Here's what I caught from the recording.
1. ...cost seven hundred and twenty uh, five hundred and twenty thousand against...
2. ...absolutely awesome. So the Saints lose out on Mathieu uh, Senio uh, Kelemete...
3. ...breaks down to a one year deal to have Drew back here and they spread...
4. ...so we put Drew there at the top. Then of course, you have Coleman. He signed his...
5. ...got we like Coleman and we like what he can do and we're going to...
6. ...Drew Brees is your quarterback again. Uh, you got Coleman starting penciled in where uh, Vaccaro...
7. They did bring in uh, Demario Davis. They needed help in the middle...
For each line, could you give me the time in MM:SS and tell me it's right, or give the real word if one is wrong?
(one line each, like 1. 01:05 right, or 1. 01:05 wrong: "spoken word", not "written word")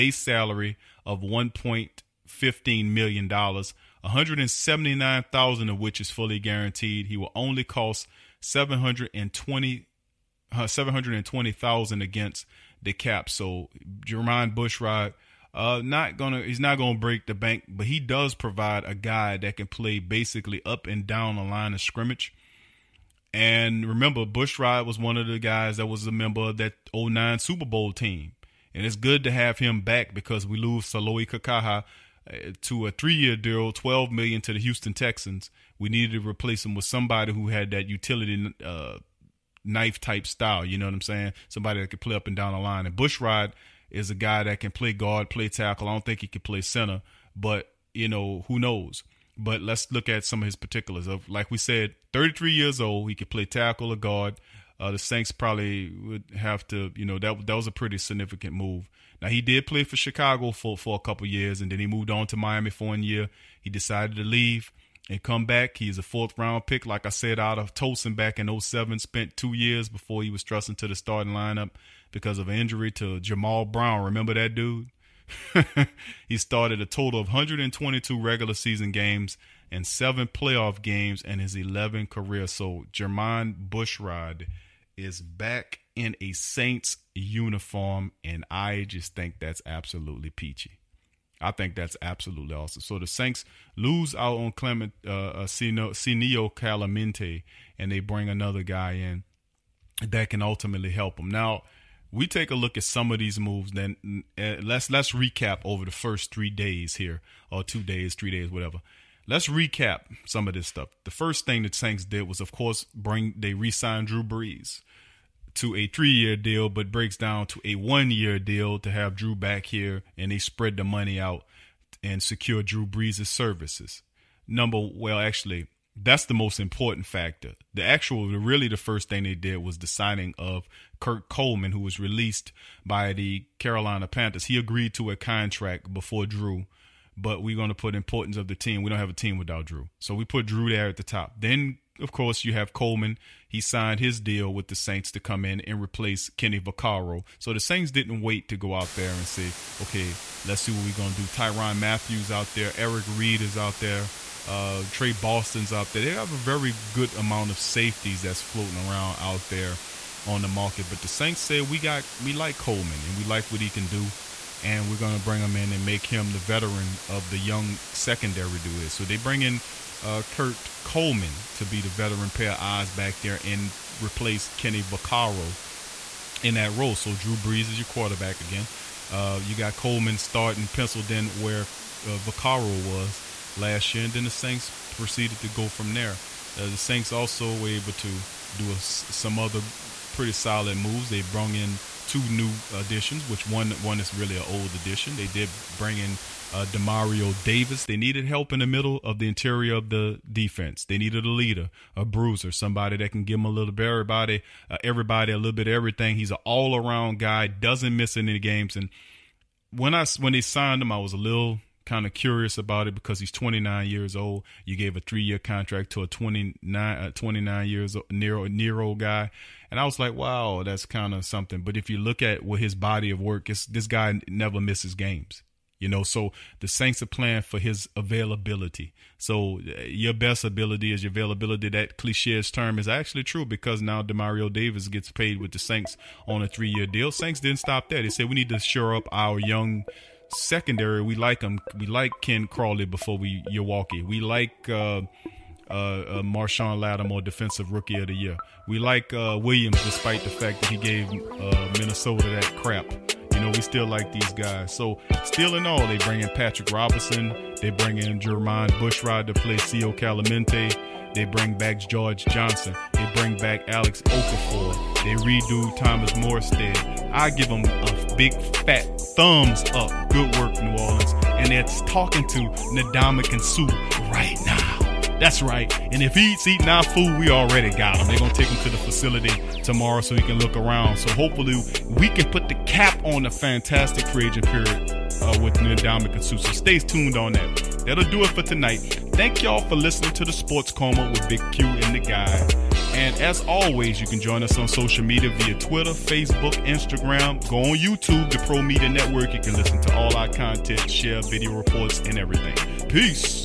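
1. 00:07 wrong: "seven", not "five"
2. 01:32 wrong: "Clement", not "Mathieu"
3. 01:56 right
4. 02:19 right
5. 02:41 right
6. 02:57 right
7. 03:15 right.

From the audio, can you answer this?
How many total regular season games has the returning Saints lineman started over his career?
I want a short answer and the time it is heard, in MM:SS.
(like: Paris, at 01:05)
122, at 01:17.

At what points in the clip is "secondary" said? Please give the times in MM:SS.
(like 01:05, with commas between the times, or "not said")
02:47, 04:00.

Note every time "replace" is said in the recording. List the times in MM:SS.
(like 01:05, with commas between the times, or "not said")
00:36, 02:25, 02:54.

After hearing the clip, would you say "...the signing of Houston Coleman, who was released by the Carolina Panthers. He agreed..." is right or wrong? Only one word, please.
wrong.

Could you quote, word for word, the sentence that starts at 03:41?
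But if you look at what his body of work is, this guy never misses games.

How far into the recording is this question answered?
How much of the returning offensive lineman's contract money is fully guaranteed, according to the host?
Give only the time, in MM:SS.
00:04.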